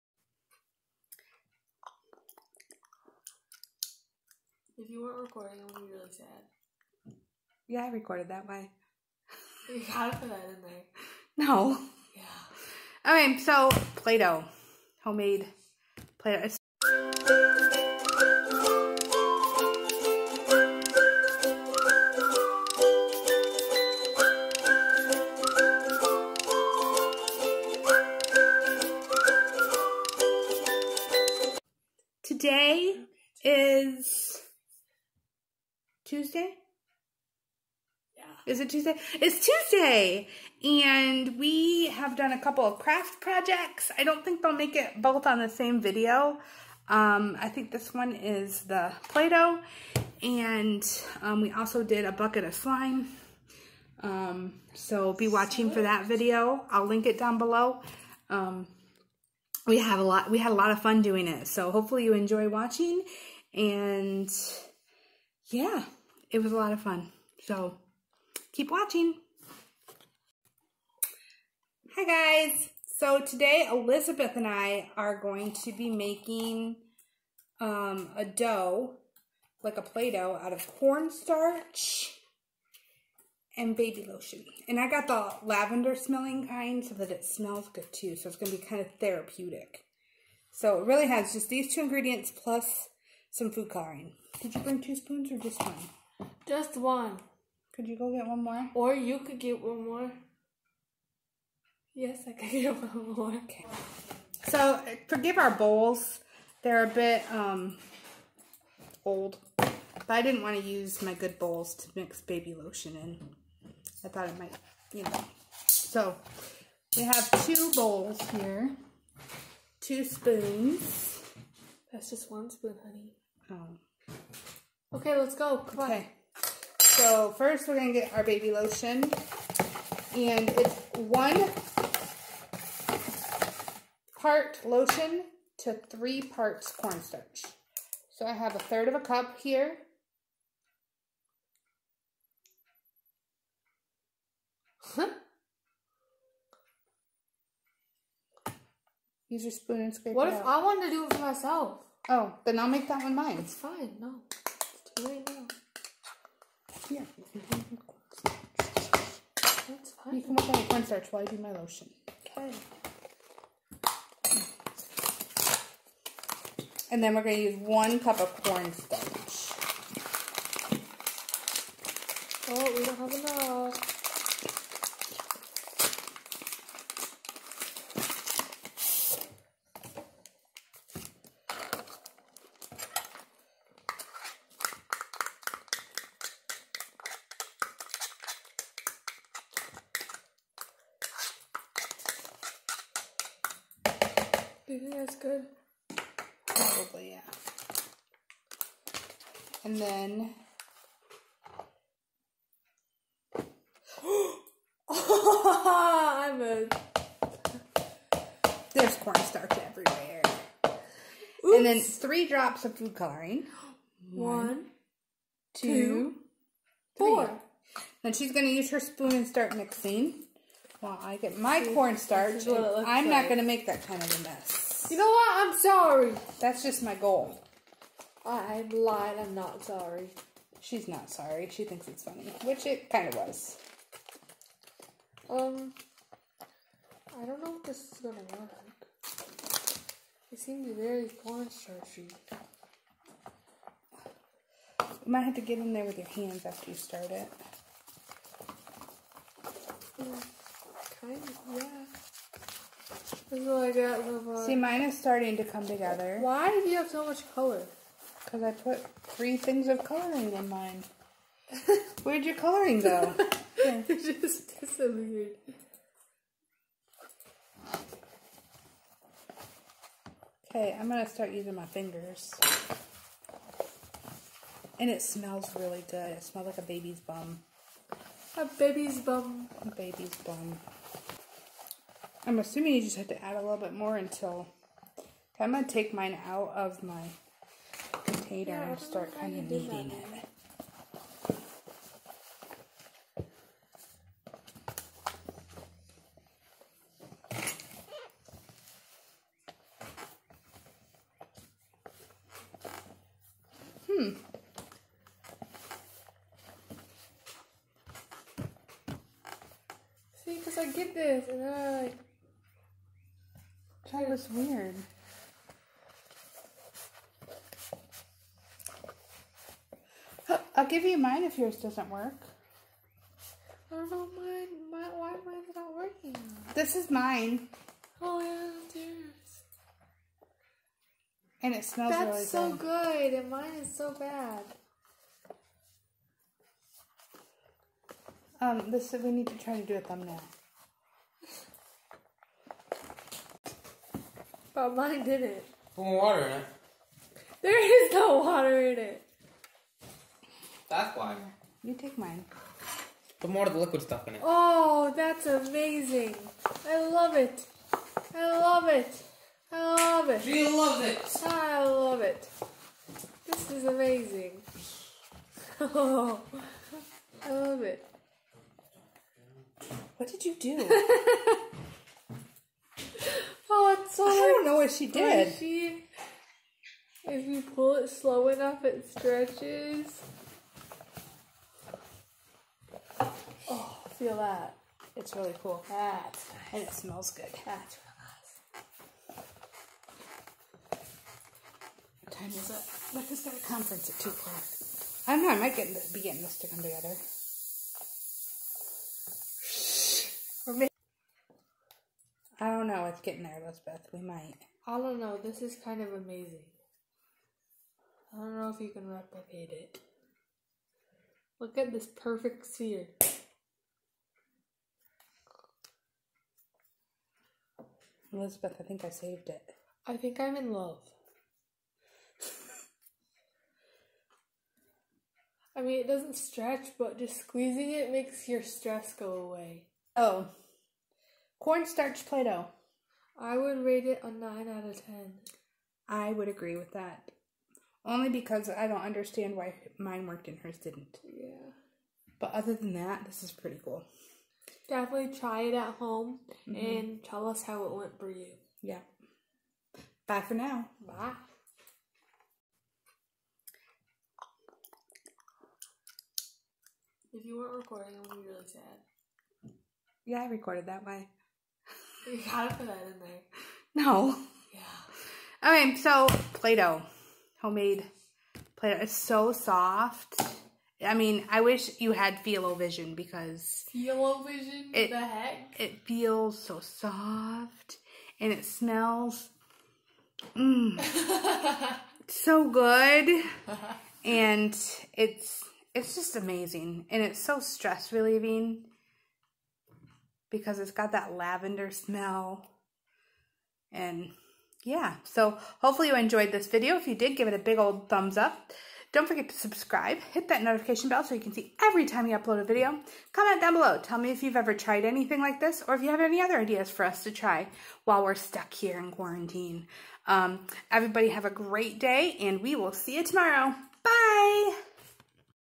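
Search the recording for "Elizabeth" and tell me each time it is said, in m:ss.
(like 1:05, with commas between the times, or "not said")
1:13, 6:43, 6:58.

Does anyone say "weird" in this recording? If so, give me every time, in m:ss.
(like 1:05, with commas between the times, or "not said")
5:14.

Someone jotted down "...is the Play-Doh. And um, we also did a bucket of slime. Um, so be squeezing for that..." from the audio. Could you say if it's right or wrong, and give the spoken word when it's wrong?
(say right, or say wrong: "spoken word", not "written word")
wrong: "watching", not "squeezing".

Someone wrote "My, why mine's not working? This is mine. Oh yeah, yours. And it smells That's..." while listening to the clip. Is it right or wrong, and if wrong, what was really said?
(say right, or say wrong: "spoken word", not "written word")
right.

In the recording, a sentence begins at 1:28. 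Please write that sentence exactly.
So it's going to be kind of therapeutic.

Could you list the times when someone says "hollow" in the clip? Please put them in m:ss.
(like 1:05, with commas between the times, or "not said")
not said.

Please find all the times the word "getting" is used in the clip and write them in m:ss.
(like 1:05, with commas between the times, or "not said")
6:36, 6:43.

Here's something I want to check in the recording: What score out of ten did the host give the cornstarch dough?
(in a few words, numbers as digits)
9.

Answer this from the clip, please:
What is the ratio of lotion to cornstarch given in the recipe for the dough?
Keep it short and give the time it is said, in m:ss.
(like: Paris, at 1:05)
1 part lotion to 3 parts cornstarch, at 2:10.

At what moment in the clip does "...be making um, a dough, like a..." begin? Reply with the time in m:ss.
1:15.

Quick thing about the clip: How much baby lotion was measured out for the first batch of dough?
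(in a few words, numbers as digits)
A third of a cup.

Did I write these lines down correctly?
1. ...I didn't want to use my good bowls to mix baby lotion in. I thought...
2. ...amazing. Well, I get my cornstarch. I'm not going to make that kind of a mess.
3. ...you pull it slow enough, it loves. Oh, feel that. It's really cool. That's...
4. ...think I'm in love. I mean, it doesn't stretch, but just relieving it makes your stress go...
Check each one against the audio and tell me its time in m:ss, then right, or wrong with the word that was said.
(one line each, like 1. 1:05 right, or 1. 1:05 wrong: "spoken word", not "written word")
1. 1:50 right
2. 3:39 wrong: "mixing", not "amazing"
3. 6:17 wrong: "stretches", not "loves"
4. 6:59 wrong: "squeezing", not "relieving".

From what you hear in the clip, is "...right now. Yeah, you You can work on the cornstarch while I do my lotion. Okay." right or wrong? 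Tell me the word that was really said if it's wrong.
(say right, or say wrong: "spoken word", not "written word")
right.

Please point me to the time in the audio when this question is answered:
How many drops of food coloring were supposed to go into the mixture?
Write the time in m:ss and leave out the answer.
3:31.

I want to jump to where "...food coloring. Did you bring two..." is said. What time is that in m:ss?
1:33.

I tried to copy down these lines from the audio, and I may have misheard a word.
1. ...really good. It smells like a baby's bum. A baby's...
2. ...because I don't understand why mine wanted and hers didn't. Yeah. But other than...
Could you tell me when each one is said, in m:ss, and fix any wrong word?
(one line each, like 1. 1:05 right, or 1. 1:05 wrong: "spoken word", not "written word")
1. 4:35 right
2. 7:18 wrong: "worked", not "wanted".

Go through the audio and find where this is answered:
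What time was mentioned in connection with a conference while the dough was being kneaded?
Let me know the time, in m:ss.
6:33.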